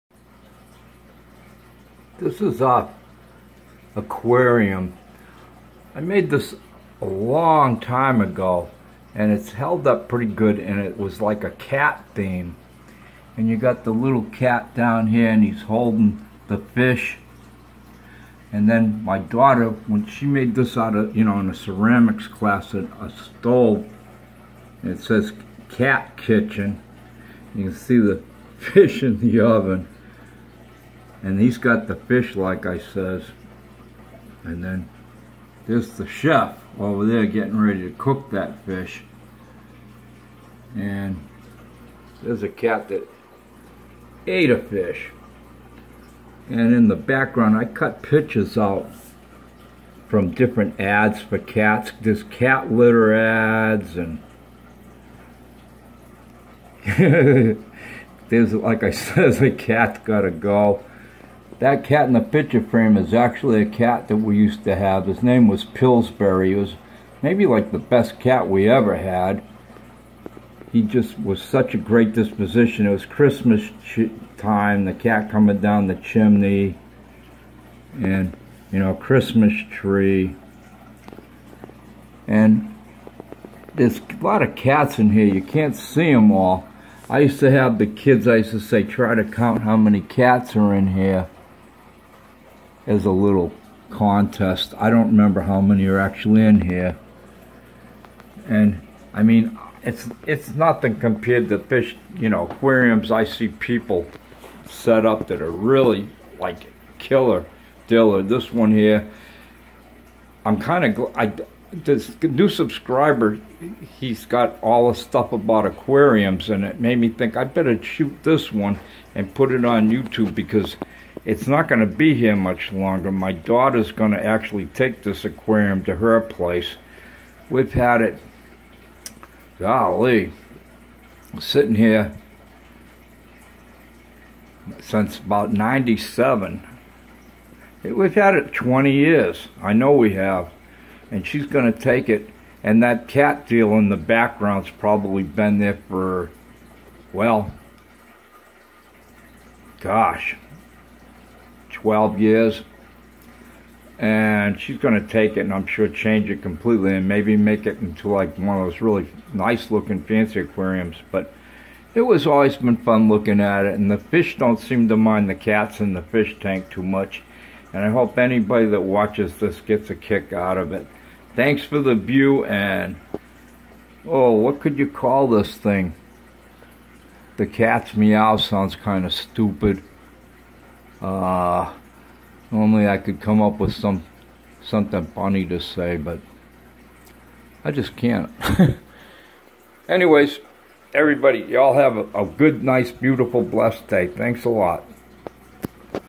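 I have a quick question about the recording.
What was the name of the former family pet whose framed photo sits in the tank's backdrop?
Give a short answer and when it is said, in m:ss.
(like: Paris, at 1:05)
Pillsbury, at 1:05.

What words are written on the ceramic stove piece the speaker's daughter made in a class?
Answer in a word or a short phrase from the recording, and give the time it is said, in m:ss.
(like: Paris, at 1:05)
Cat kitchen, at 0:25.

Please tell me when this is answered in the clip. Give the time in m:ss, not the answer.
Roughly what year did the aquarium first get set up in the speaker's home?
2:15.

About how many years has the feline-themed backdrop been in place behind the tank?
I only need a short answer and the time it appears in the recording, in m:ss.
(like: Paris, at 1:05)
12, at 2:31.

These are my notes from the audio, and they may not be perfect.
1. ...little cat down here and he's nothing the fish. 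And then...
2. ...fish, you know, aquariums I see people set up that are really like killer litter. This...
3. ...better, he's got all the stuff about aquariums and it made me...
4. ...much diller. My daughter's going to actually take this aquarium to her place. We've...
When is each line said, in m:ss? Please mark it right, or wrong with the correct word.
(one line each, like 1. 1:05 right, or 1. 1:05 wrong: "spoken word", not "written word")
1. 0:13 wrong: "holding", not "nothing"
2. 1:41 wrong: "diller", not "litter"
3. 1:52 wrong: "subscriber", not "better"
4. 2:02 wrong: "longer", not "diller".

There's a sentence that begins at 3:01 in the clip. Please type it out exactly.
Uh, normally I could come up with some something funny to say, but I just can't.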